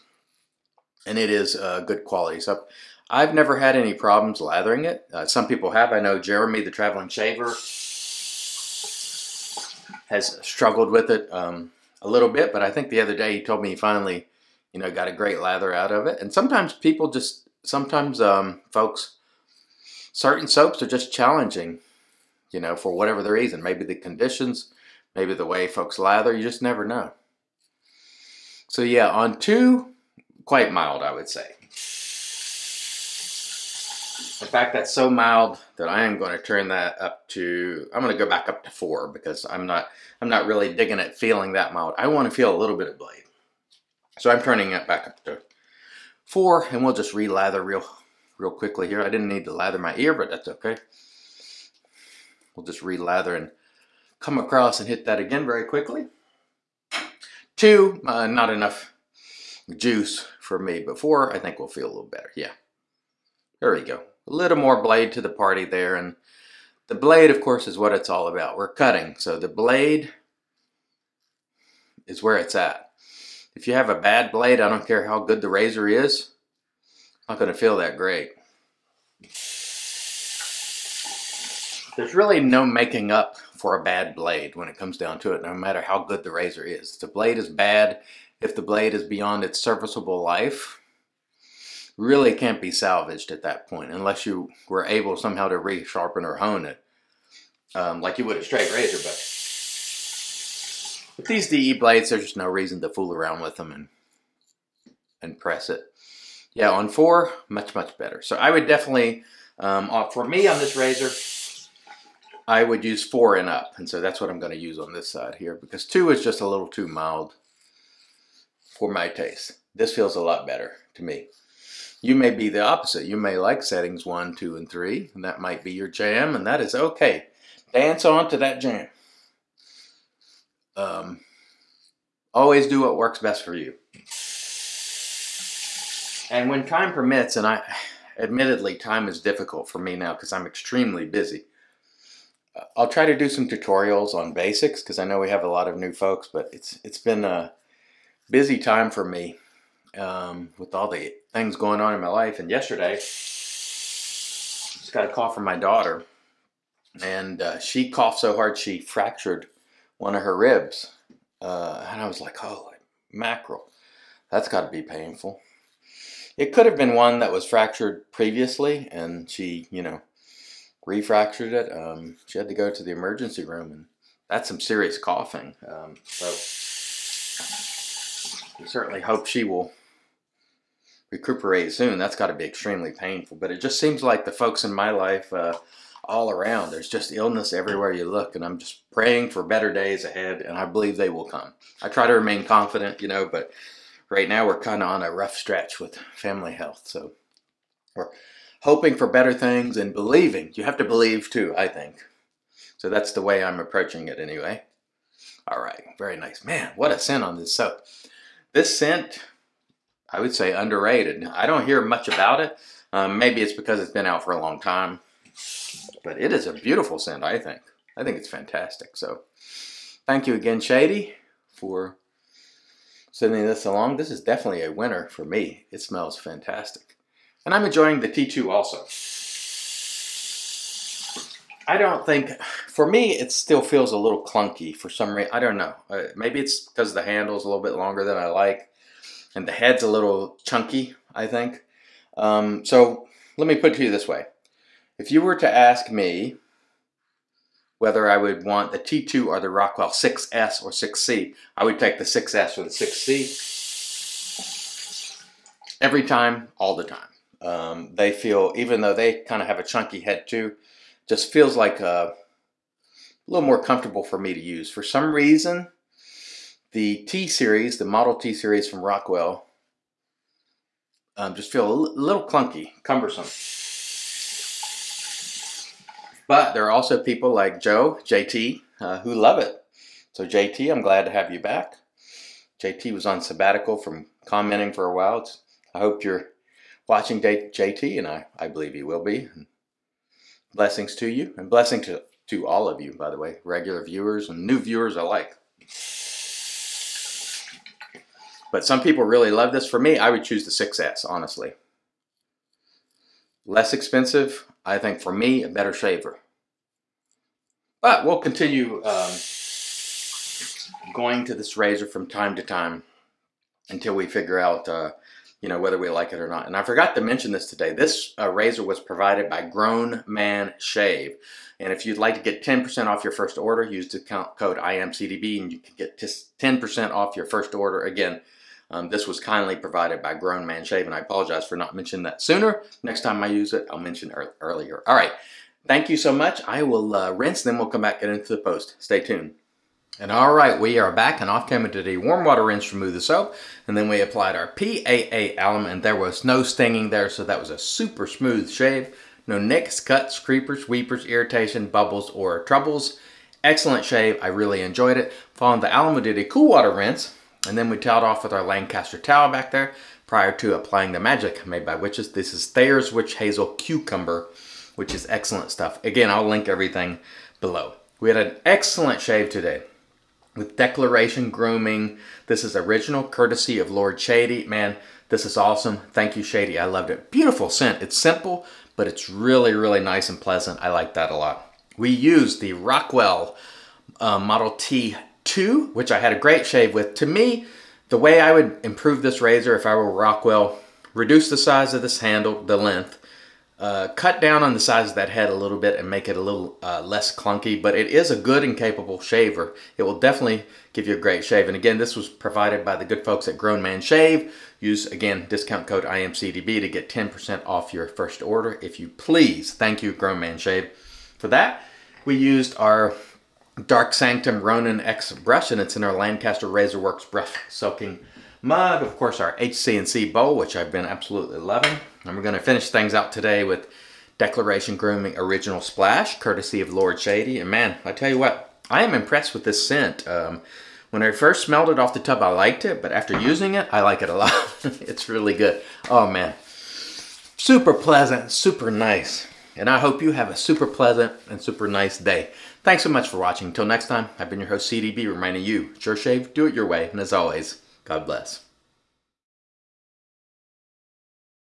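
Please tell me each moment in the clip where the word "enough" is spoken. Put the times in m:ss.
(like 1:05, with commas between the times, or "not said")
0:58.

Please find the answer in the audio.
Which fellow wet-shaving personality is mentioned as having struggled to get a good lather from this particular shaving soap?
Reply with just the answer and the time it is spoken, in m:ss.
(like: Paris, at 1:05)
Jeremy, at 0:06.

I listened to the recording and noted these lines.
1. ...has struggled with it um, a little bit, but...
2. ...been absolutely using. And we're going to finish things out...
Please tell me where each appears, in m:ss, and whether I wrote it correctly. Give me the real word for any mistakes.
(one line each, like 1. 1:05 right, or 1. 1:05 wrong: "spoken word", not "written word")
1. 0:10 right
2. 7:00 wrong: "loving", not "using".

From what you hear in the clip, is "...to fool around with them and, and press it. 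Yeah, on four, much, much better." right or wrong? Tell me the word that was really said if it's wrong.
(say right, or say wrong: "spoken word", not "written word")
right.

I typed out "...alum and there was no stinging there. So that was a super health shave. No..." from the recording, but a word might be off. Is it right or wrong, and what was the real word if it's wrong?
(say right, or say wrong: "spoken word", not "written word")
wrong: "smooth", not "health".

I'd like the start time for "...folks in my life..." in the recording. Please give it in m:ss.
3:04.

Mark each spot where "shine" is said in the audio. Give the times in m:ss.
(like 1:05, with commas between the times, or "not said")
not said.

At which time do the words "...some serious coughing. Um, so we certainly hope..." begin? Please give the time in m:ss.
2:54.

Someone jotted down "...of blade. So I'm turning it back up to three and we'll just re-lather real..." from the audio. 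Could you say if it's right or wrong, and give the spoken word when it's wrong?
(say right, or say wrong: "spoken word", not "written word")
wrong: "four", not "three".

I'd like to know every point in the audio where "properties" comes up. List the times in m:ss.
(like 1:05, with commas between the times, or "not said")
not said.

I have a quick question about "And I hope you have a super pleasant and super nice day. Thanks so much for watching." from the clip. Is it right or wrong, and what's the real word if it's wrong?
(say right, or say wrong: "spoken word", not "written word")
right.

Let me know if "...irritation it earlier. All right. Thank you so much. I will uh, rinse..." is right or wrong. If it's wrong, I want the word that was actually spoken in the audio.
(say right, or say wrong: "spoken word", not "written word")
wrong: "mention", not "irritation".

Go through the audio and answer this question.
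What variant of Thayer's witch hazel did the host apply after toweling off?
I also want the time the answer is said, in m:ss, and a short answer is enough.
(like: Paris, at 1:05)
Cucumber, at 6:03.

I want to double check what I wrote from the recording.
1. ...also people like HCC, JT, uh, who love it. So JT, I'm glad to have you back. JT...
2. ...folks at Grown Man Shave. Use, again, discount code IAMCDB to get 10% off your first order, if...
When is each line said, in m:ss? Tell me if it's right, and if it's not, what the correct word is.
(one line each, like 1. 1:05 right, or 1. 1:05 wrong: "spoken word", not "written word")
1. 4:36 wrong: "Joe", not "HCC"
2. 6:43 right.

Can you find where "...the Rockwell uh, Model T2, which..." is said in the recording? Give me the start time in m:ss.
6:22.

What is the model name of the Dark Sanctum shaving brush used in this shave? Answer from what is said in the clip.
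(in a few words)
Ronin X.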